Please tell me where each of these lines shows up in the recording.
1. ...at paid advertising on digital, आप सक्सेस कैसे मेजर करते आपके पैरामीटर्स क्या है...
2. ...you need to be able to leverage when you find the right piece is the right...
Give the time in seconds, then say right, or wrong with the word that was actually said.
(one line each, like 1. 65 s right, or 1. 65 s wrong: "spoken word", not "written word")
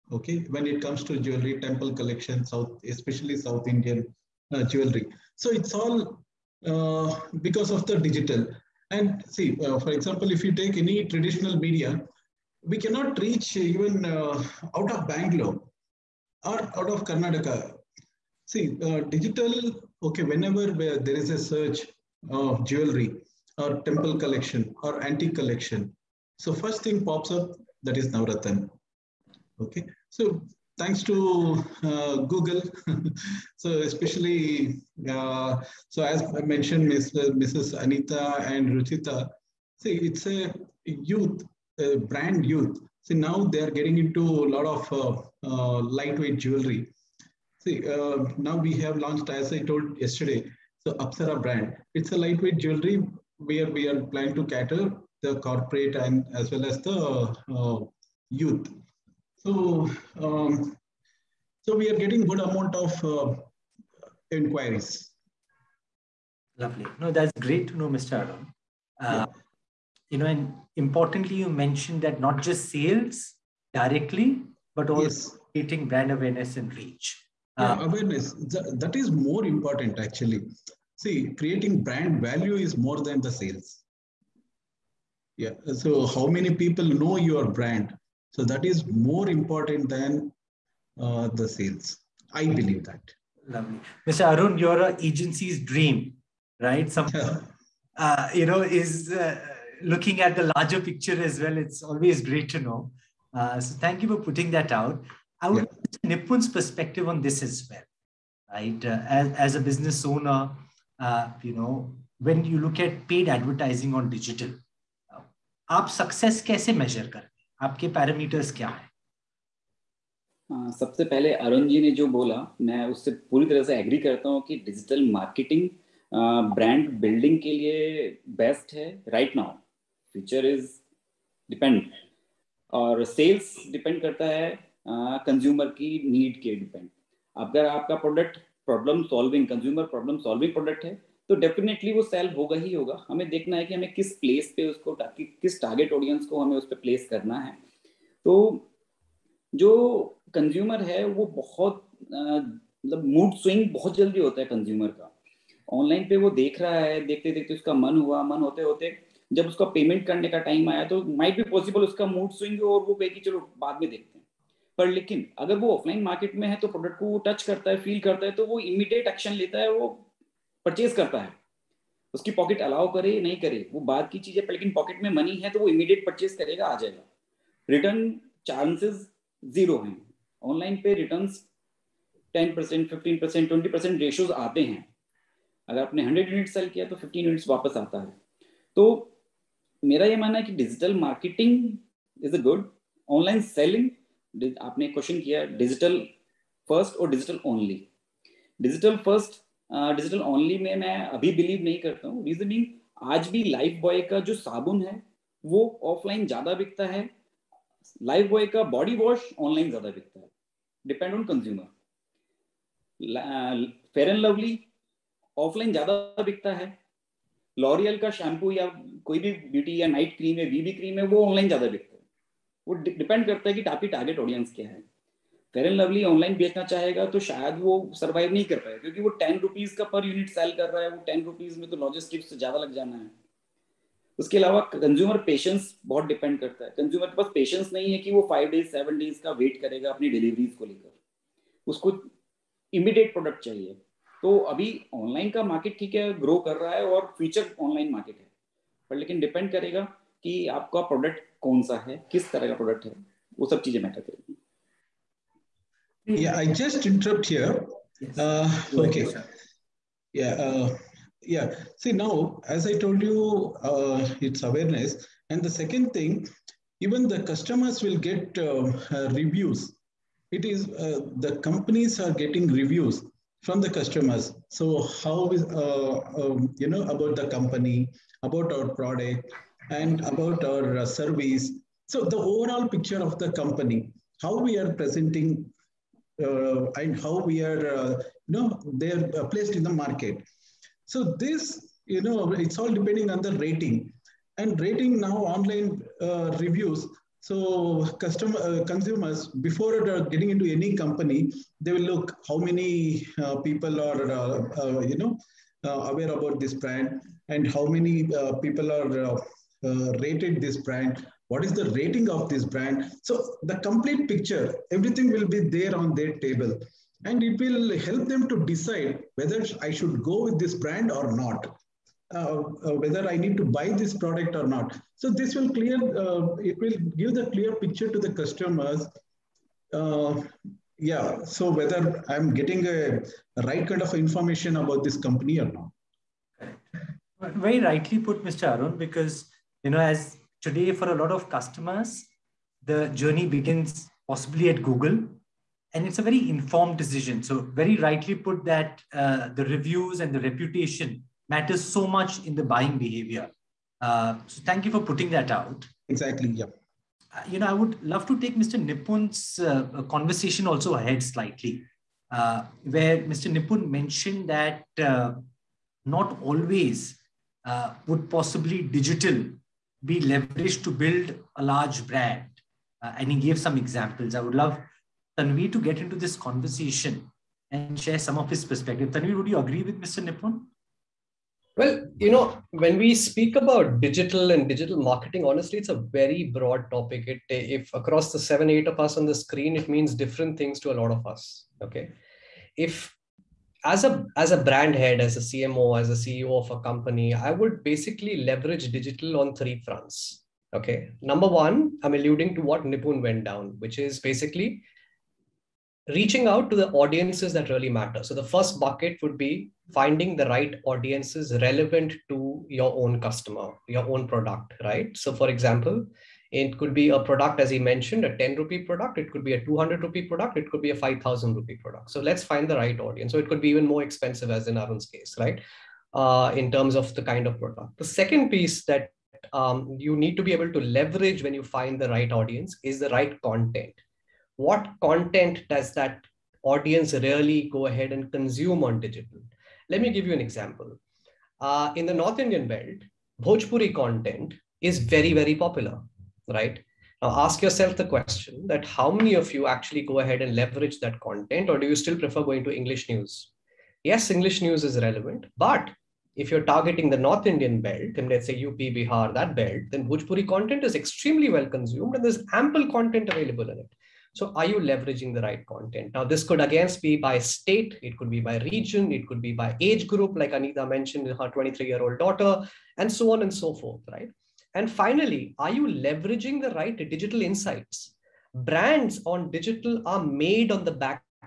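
1. 112 s right
2. 429 s wrong: "audience", not "piece".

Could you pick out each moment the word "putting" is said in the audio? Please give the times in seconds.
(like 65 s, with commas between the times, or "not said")
104 s, 354 s.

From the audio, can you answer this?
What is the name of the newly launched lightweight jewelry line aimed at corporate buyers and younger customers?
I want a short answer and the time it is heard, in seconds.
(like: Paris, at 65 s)
Apsara, at 50 s.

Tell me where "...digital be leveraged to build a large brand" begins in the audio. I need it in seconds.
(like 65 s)
368 s.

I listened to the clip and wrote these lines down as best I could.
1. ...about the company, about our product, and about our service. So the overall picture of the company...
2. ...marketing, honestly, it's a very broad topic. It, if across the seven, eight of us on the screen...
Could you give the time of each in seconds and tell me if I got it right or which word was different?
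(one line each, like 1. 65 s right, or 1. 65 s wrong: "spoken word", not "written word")
1. 276 s right
2. 384 s right.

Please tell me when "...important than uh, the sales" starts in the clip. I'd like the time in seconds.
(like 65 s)
89 s.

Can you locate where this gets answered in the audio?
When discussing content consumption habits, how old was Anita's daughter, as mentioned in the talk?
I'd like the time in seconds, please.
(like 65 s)
471 s.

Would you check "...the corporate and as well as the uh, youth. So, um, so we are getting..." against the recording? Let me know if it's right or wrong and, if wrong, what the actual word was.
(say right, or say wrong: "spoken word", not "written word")
right.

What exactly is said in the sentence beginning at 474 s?
And finally, are you leveraging the right digital insights?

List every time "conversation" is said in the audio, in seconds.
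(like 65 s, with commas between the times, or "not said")
359 s, 376 s.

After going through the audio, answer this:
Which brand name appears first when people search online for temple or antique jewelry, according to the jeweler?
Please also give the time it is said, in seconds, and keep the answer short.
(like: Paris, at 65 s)
Navratan, at 28 s.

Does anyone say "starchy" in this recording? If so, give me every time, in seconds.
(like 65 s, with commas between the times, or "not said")
not said.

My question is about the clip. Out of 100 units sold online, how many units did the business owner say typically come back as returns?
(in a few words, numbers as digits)
15.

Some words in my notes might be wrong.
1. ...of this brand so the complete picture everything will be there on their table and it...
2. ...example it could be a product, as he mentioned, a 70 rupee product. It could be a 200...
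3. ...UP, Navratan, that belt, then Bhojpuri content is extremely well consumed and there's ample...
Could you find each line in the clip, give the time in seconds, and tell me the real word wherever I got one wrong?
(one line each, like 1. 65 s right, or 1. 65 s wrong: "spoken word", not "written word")
1. 312 s right
2. 415 s wrong: "10", not "70"
3. 458 s wrong: "Bihar", not "Navratan".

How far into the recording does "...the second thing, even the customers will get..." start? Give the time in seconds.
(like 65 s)
265 s.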